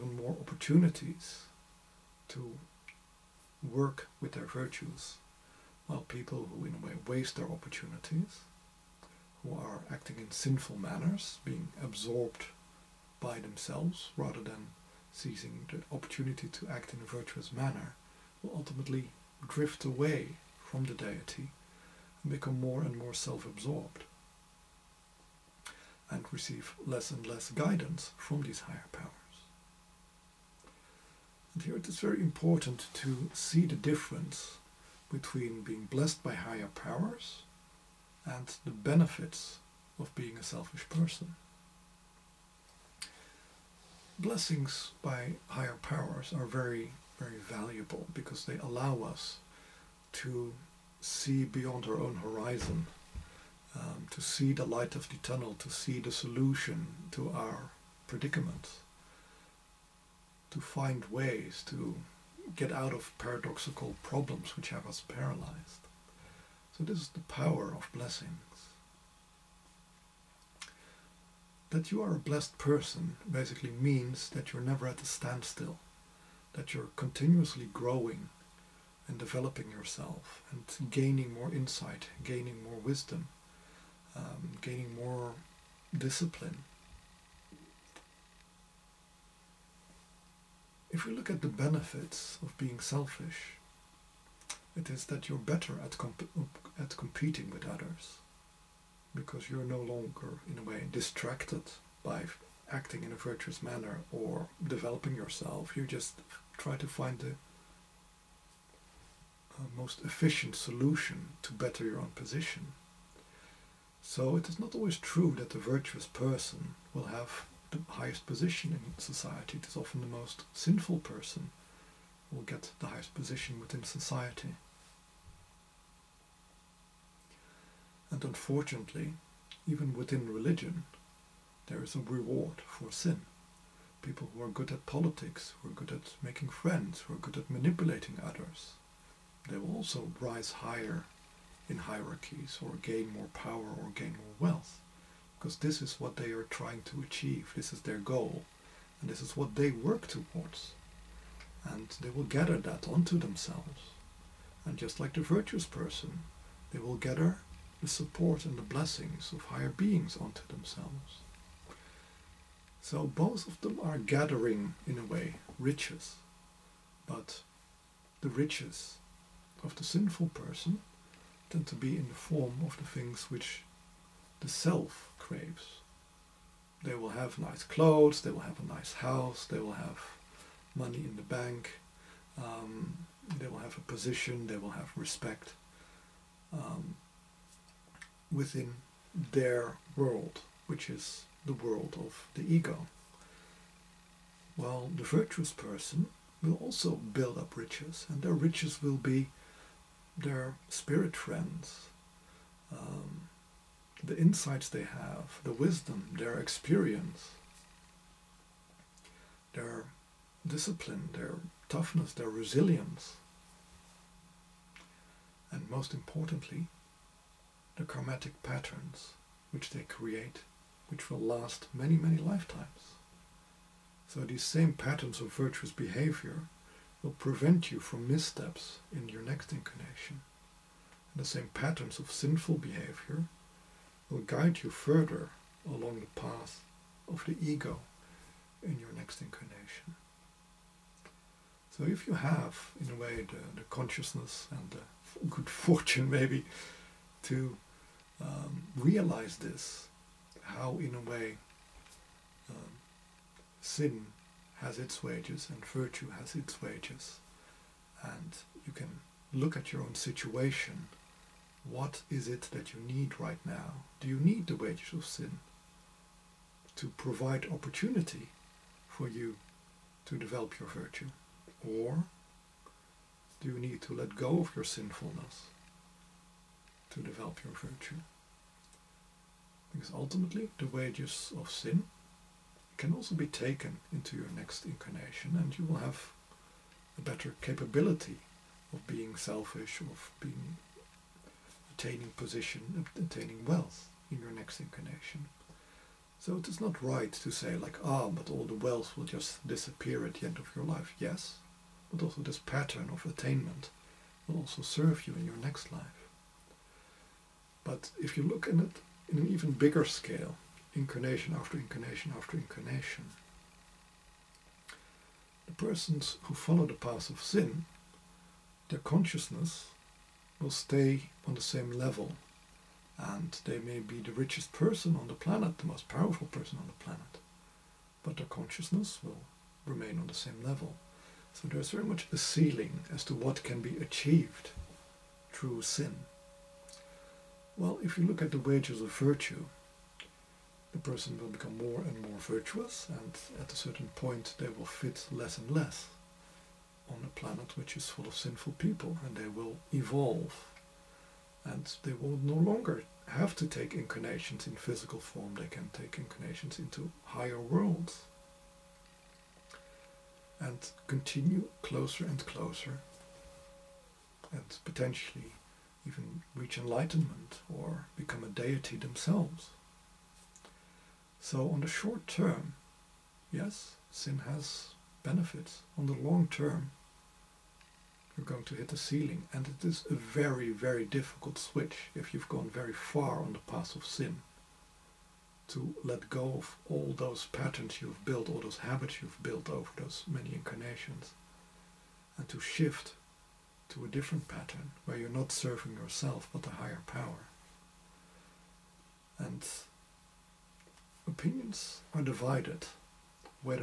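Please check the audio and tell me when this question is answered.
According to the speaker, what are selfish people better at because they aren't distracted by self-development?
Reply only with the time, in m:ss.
1:36.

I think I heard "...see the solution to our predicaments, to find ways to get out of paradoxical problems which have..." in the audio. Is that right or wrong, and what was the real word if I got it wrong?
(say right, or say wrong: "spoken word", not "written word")
right.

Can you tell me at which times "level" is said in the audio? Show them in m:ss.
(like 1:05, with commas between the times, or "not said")
5:21, 5:30.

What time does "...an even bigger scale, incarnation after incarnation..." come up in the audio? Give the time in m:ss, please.
5:09.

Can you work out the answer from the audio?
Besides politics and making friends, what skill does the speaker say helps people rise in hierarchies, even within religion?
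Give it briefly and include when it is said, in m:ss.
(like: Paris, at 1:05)
manipulating others, at 2:17.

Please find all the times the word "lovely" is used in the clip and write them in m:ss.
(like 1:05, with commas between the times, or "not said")
not said.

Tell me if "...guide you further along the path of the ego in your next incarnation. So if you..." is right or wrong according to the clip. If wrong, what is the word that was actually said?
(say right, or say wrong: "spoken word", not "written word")
right.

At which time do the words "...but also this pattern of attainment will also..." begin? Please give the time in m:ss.
5:01.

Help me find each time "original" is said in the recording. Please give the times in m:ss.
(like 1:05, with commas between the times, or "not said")
not said.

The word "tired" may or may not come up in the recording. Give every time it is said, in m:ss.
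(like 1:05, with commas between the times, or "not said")
not said.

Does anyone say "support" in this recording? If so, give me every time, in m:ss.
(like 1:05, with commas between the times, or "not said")
2:37.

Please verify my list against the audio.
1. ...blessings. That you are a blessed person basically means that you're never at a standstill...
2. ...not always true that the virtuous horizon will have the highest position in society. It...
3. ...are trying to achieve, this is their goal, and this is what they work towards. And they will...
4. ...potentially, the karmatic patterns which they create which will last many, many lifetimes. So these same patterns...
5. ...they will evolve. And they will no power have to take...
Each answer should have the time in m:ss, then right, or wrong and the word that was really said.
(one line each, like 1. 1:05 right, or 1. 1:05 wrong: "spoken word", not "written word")
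1. 1:07 right
2. 1:54 wrong: "person", not "horizon"
3. 2:26 right
4. 3:35 wrong: "importantly", not "potentially"
5. 5:49 wrong: "longer", not "power".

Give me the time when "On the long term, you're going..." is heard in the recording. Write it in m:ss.
6:15.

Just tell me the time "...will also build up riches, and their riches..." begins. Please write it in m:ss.
3:16.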